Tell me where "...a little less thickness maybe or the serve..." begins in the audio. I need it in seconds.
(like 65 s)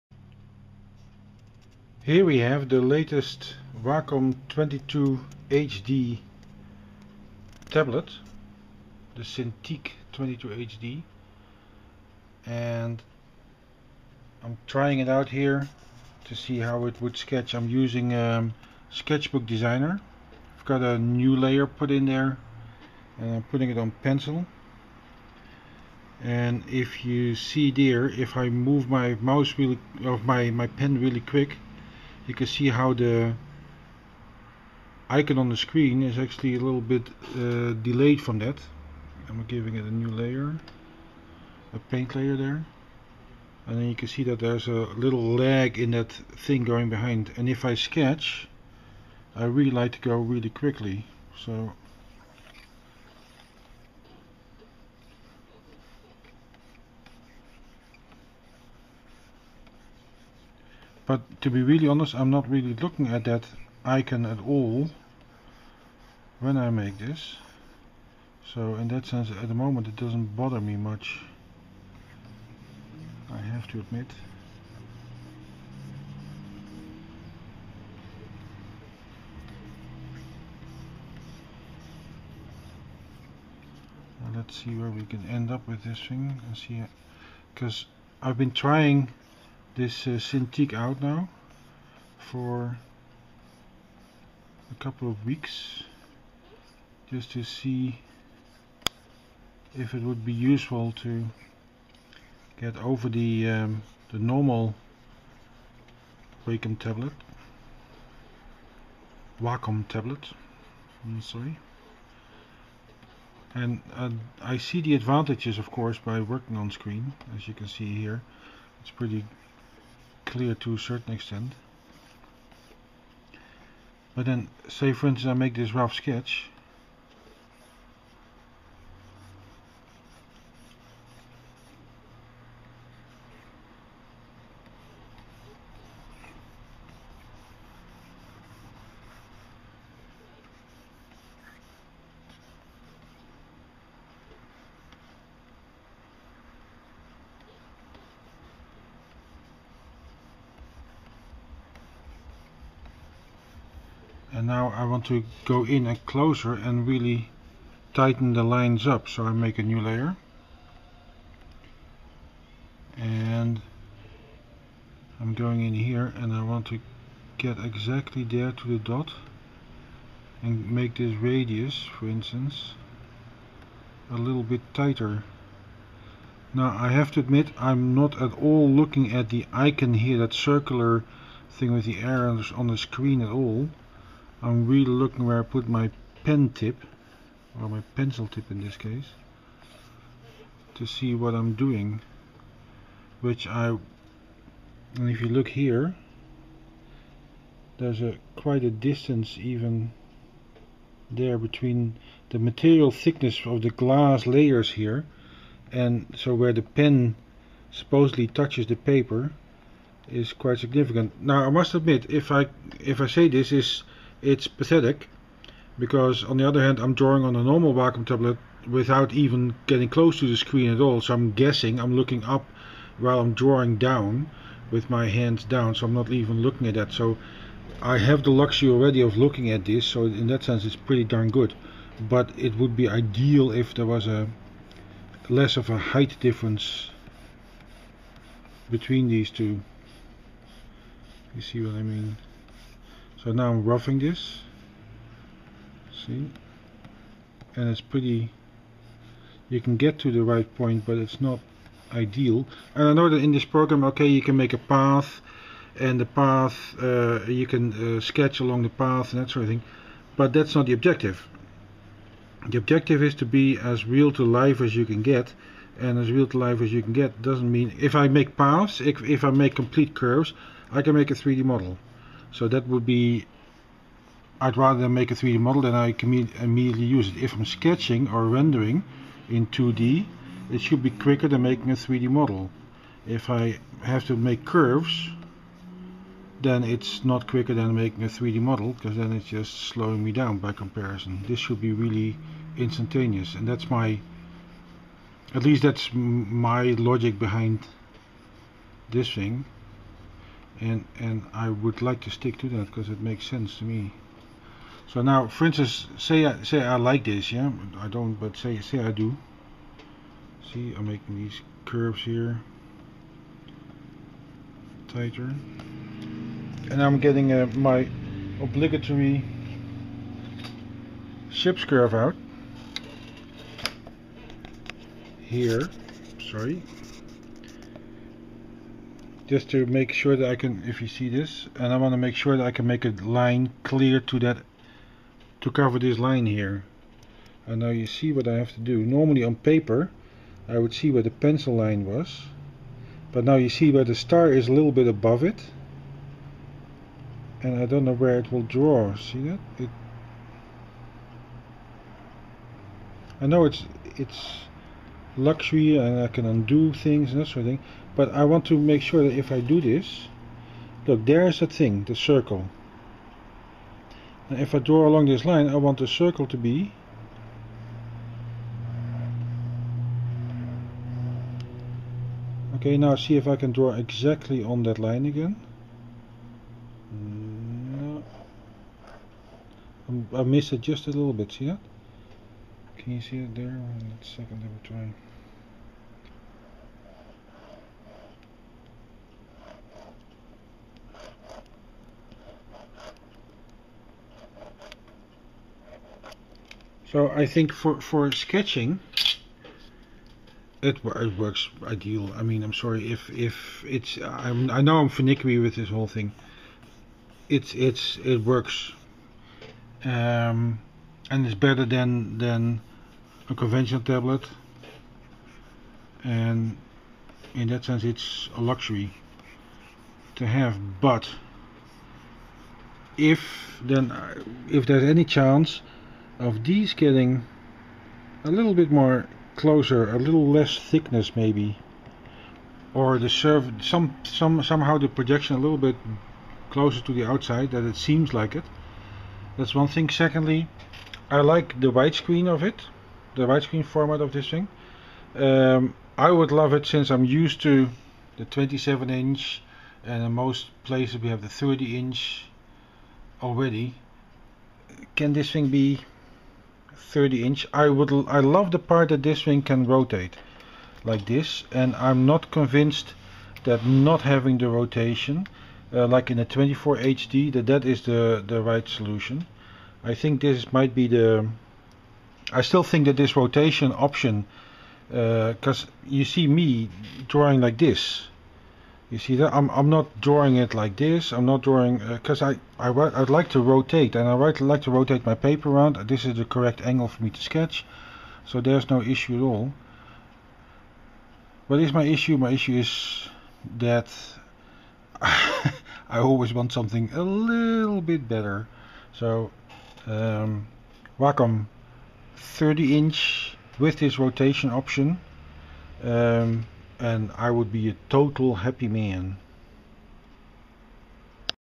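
429 s.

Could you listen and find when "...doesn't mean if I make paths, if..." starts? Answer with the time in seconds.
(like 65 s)
267 s.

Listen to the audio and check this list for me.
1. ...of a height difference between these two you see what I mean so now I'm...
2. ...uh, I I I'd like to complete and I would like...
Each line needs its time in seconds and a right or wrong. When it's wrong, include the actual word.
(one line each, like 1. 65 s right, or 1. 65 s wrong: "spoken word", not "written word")
1. 235 s right
2. 482 s wrong: "rotate", not "complete".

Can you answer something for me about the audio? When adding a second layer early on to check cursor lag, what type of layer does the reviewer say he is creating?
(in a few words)
paint layer.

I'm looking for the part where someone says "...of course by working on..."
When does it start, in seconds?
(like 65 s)
115 s.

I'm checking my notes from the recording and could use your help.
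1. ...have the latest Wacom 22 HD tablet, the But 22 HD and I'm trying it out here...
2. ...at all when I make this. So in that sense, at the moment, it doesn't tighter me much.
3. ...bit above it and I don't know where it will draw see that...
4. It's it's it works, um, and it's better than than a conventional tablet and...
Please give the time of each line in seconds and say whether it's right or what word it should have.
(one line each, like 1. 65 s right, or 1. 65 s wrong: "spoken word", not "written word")
1. 2 s wrong: "Cintiq", not "But"
2. 64 s wrong: "bother", not "tighter"
3. 344 s right
4. 407 s right.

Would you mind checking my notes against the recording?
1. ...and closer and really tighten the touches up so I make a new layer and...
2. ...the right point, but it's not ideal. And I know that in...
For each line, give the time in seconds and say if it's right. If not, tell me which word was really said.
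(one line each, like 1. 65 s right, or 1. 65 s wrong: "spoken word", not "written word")
1. 155 s wrong: "lines", not "touches"
2. 250 s right.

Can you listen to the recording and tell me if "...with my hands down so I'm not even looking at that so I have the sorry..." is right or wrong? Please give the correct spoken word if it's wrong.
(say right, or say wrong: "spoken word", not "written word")
wrong: "luxury", not "sorry".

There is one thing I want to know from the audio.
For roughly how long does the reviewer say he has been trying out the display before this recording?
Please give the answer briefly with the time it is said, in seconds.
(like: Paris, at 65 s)
a couple of weeks, at 94 s.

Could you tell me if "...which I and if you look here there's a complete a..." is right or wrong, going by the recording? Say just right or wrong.
wrong.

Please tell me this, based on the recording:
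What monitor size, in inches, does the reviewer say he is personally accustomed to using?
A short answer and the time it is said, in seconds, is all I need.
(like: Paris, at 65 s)
27 inch, at 448 s.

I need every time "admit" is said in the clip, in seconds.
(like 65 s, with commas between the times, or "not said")
73 s, 177 s, 211 s.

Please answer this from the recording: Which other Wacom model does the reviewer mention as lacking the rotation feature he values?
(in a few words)
24 HD.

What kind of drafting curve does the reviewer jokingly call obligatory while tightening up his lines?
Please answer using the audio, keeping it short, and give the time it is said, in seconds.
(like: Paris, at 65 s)
ship's curve, at 321 s.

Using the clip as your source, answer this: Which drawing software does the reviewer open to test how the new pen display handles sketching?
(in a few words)
Sketchbook Designer.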